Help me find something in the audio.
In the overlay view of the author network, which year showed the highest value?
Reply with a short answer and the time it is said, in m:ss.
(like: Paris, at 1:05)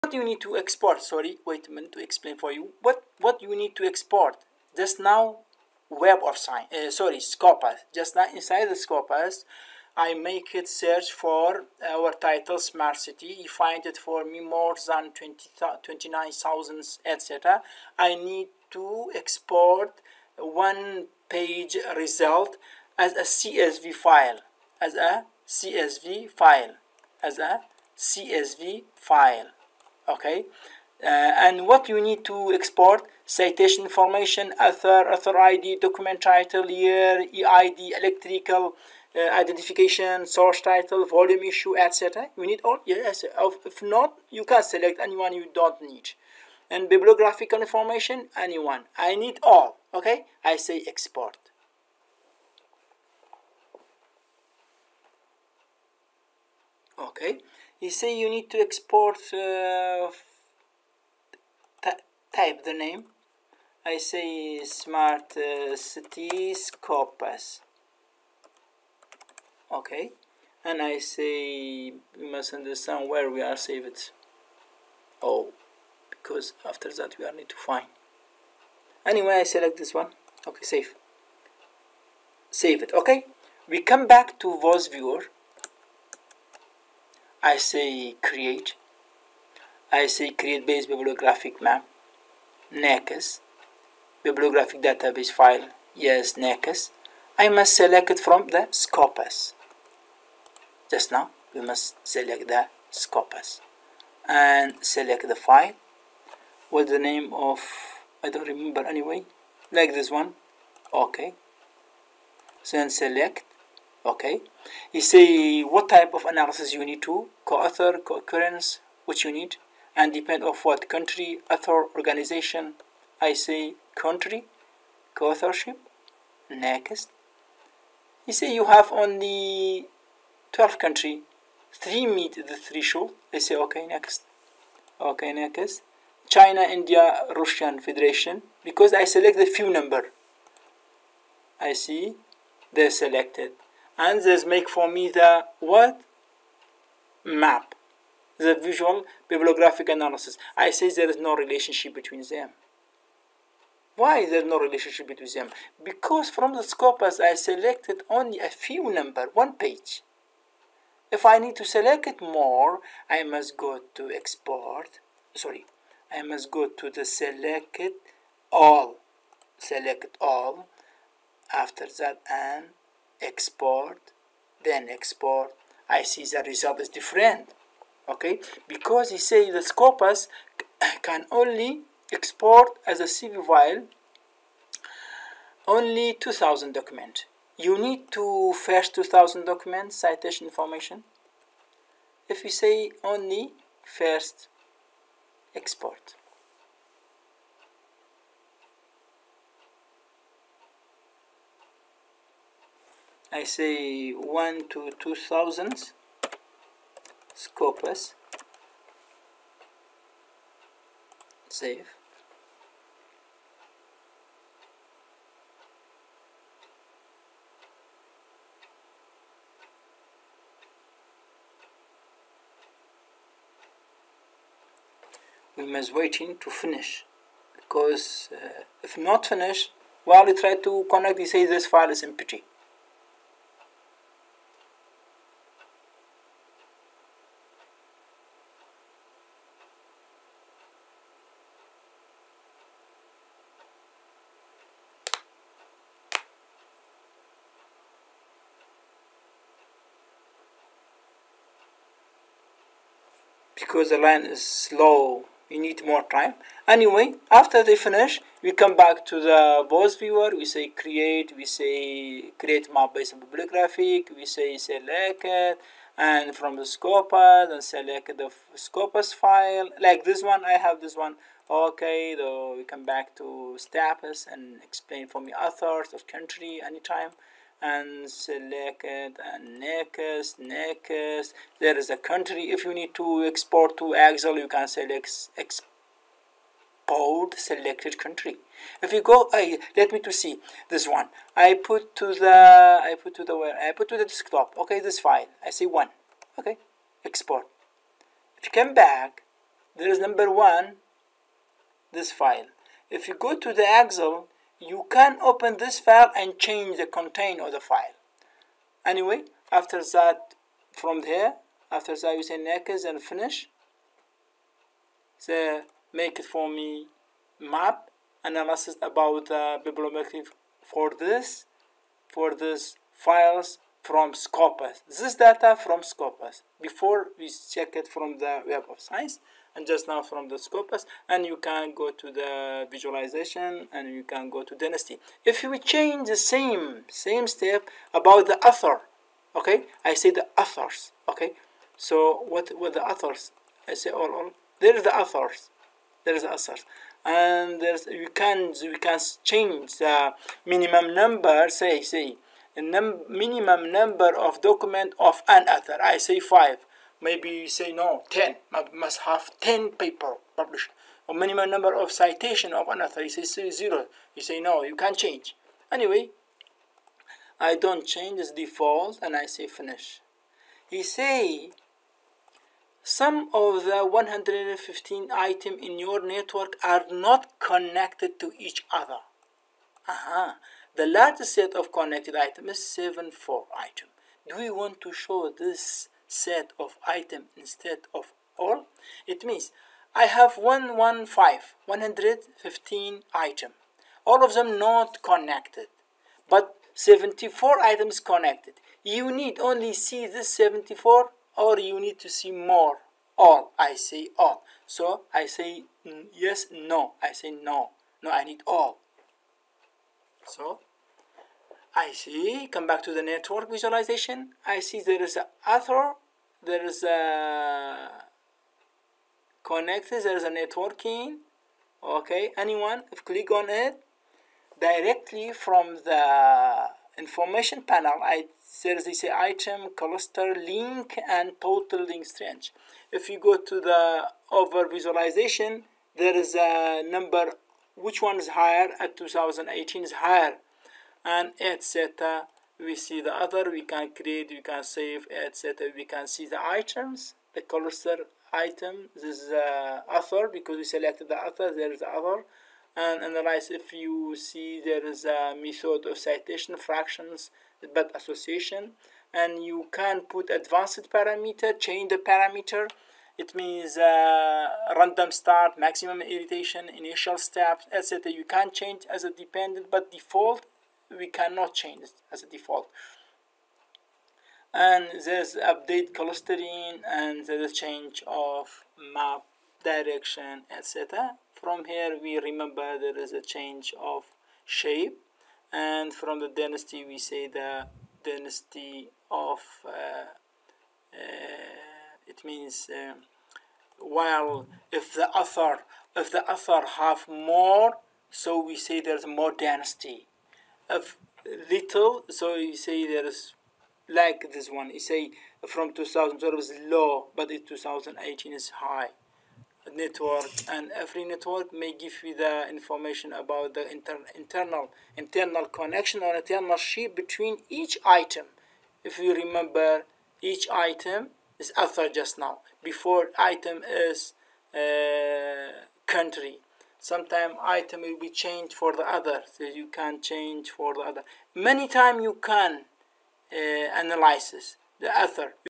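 2018, at 7:18.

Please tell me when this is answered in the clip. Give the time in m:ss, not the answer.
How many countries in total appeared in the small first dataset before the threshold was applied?
2:10.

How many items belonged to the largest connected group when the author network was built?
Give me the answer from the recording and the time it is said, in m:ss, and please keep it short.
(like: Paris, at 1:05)
74, at 6:22.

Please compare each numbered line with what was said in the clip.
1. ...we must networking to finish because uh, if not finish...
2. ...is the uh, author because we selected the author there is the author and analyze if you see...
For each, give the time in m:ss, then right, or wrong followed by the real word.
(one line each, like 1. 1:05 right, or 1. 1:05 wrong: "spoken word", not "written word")
1. 3:45 wrong: "waiting", not "networking"
2. 7:29 right.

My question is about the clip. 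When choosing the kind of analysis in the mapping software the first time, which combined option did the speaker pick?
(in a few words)
country co-authorship.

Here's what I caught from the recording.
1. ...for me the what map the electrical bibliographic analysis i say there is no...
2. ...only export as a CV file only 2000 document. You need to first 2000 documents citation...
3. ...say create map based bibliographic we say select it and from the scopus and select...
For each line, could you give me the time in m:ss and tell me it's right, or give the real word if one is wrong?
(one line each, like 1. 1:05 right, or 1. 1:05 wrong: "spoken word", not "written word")
1. 2:24 wrong: "visual", not "electrical"
2. 3:01 right
3. 4:21 right.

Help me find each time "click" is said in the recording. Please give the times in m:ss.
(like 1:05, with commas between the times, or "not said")
7:03.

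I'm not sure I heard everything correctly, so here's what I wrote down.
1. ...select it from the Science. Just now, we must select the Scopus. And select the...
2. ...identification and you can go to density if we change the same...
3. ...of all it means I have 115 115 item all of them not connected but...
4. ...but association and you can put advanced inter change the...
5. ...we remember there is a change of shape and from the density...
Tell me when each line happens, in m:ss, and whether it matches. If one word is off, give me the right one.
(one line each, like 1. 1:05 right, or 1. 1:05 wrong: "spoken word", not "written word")
1. 1:37 wrong: "Scopus", not "Science"
2. 5:32 wrong: "visualization", not "identification"
3. 6:27 right
4. 7:37 wrong: "parameter", not "inter"
5. 8:02 right.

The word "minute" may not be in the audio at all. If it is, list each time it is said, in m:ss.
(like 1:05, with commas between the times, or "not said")
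0:01.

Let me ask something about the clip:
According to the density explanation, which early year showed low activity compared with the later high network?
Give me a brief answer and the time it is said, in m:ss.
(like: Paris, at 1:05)
2012, at 8:25.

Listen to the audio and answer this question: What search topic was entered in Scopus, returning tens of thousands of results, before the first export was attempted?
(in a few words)
smart city.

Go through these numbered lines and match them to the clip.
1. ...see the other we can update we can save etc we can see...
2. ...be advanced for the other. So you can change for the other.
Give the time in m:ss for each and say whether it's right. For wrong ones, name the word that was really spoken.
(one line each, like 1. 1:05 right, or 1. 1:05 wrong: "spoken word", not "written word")
1. 7:22 wrong: "create", not "update"
2. 8:48 wrong: "changed", not "advanced".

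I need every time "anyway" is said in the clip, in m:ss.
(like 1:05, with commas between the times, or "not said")
1:19, 1:48, 4:16, 5:08, 6:05.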